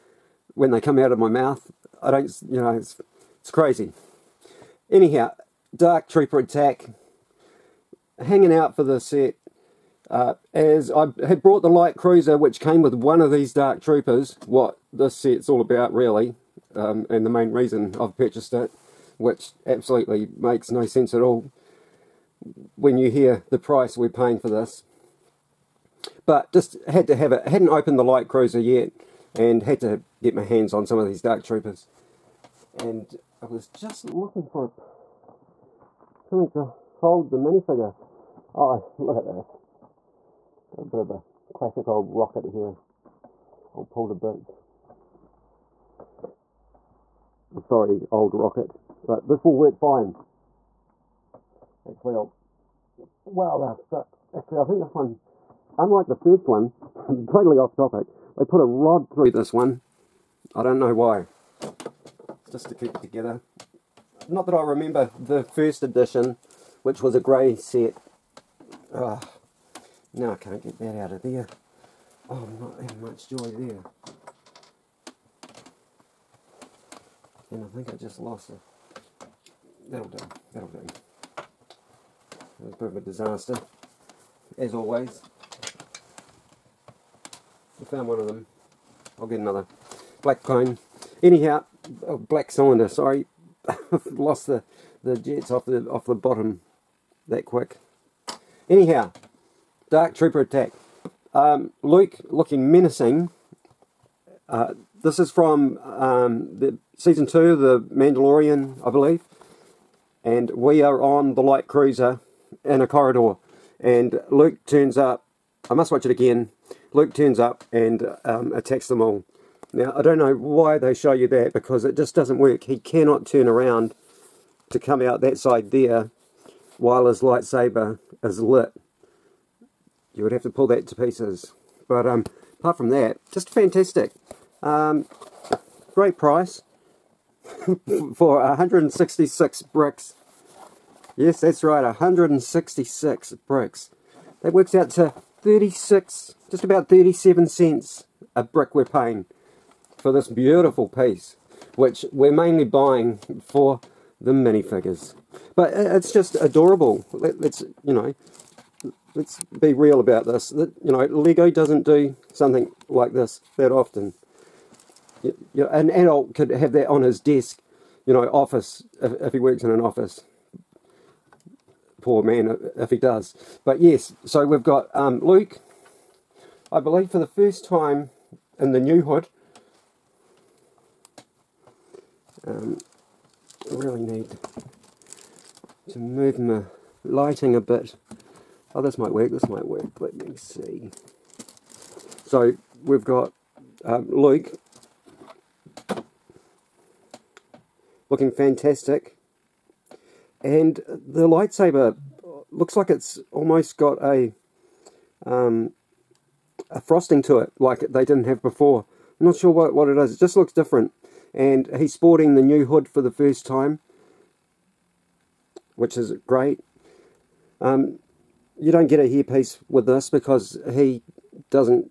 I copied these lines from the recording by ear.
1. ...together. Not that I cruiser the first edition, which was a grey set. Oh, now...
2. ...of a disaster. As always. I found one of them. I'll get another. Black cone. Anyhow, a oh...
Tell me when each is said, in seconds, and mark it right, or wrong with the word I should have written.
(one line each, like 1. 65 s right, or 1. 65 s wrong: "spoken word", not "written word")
1. 63 s wrong: "remember", not "cruiser"
2. 82 s right.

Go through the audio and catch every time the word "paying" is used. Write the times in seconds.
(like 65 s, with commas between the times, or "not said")
24 s, 148 s.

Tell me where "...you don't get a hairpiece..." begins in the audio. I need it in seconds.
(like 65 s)
218 s.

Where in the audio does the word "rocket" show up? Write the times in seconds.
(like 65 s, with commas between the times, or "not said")
42 s, 48 s.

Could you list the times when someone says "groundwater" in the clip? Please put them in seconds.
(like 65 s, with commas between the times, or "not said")
not said.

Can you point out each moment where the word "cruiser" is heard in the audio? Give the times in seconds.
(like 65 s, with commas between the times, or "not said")
11 s, 28 s, 111 s.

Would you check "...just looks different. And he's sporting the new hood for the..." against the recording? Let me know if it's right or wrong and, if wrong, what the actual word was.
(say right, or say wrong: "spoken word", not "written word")
right.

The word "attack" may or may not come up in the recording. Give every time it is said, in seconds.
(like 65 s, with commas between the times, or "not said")
6 s, 100 s, 118 s.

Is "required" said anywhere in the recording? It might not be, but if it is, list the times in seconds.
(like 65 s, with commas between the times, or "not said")
not said.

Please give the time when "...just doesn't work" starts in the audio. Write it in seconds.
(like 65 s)
121 s.